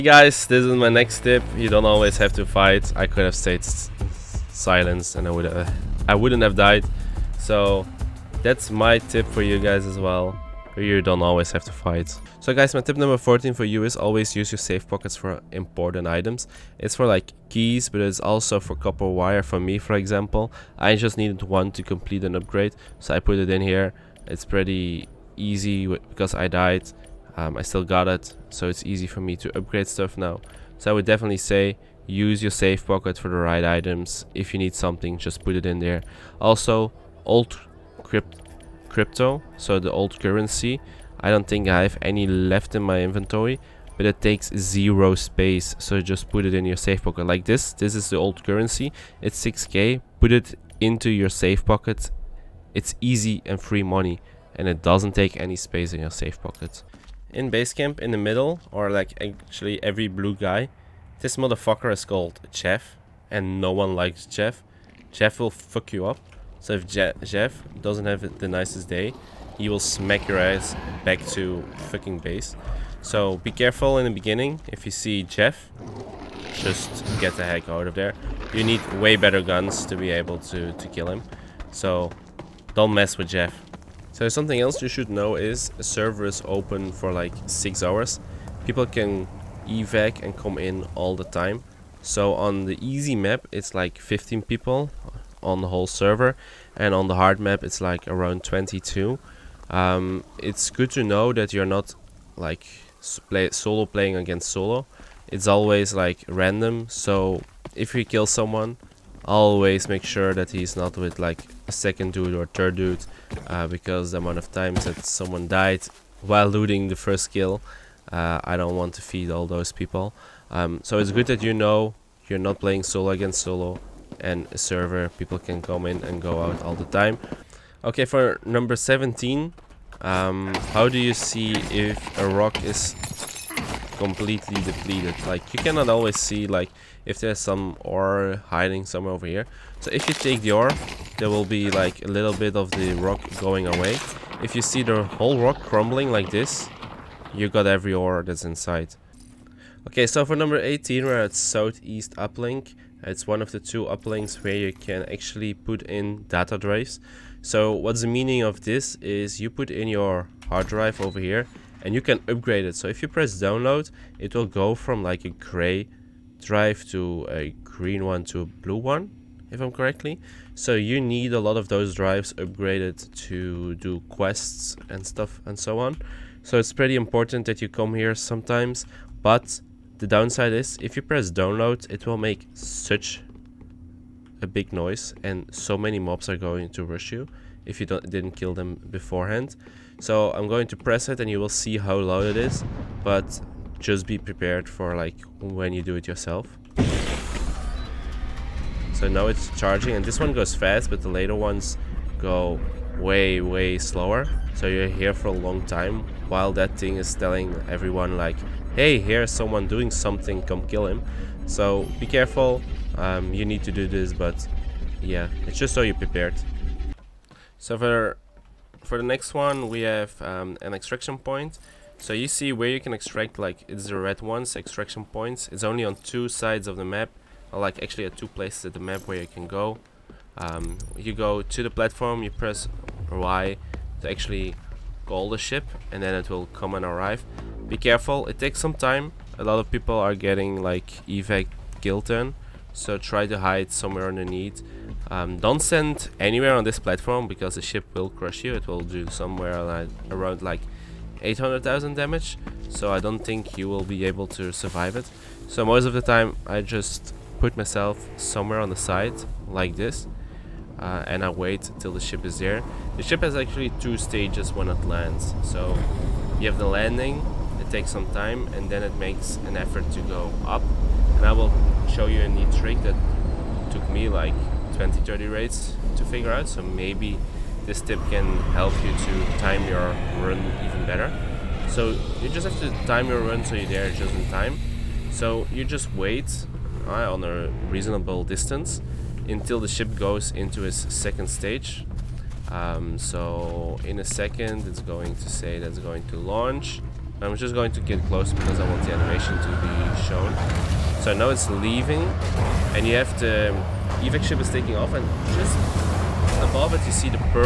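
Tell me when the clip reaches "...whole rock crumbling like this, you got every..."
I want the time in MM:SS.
02:25.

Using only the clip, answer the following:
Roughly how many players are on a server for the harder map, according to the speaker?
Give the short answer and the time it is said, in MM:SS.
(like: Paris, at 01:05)
22, at 01:38.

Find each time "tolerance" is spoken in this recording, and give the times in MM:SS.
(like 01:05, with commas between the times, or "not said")
not said.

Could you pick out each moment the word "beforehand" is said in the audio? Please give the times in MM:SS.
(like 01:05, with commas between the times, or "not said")
03:08.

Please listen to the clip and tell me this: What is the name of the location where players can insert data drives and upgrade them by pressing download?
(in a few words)
Southeast Uplink.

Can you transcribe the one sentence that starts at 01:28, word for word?
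People can evac and come in all the time.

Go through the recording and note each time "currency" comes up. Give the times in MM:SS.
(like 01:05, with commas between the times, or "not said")
00:40, 00:48.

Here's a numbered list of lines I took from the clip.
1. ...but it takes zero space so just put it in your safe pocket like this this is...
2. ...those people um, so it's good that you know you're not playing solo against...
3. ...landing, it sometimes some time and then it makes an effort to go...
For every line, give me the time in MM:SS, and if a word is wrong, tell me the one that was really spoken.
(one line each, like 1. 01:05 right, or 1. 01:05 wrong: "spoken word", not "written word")
1. 00:43 right
2. 01:59 right
3. 04:26 wrong: "takes", not "sometimes".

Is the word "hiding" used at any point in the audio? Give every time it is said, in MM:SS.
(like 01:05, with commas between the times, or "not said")
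02:18.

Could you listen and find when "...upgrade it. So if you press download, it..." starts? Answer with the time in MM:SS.
02:42.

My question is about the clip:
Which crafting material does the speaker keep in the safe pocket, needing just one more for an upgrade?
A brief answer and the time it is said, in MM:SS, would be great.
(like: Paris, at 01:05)
Copper wire, at 00:18.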